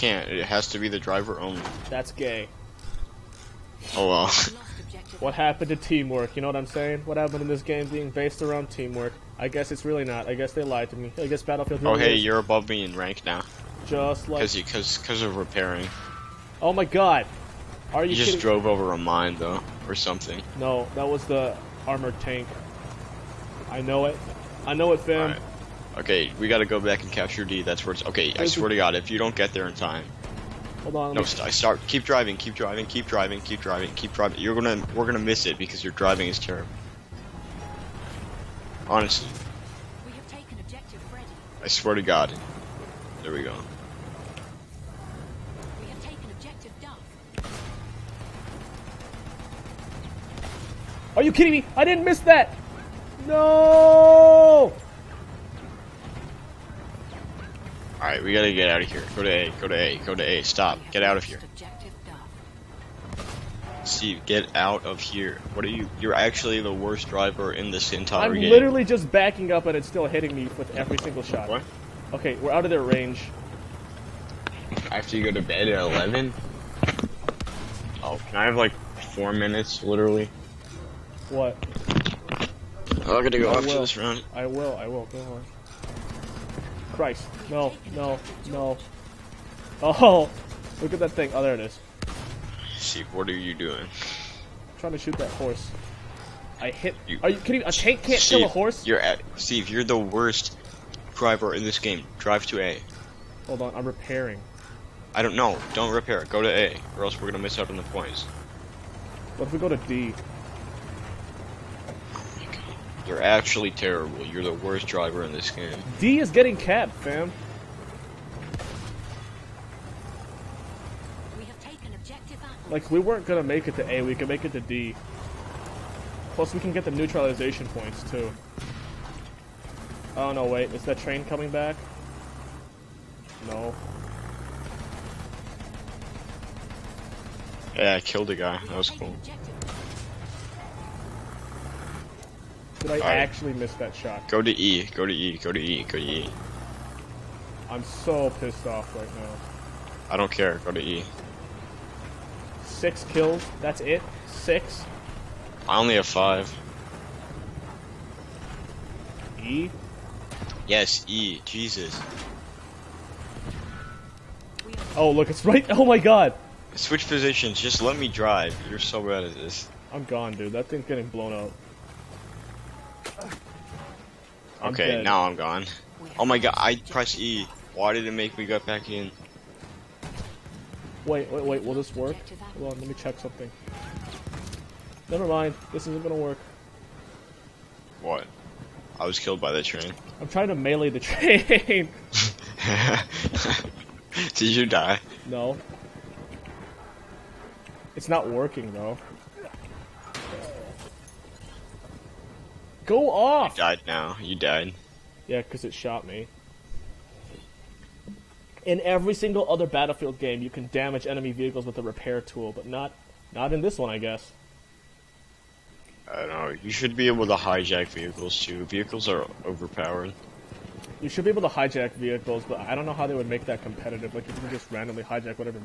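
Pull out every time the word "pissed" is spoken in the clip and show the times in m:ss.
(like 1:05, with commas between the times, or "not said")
2:28.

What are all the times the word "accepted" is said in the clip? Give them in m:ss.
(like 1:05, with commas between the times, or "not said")
not said.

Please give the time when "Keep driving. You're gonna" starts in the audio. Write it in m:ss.
0:33.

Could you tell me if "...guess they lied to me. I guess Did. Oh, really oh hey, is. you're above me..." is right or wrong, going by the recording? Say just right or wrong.
wrong.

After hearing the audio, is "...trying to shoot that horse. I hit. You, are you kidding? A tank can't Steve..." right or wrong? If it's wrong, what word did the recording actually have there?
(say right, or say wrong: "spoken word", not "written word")
right.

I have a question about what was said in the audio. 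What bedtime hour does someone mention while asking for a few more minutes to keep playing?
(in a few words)
11.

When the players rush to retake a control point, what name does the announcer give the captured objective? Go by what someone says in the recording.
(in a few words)
Freddy.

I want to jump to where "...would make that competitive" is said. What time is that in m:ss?
3:43.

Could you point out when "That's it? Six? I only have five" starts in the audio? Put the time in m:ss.
2:33.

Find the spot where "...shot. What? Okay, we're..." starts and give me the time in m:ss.
1:11.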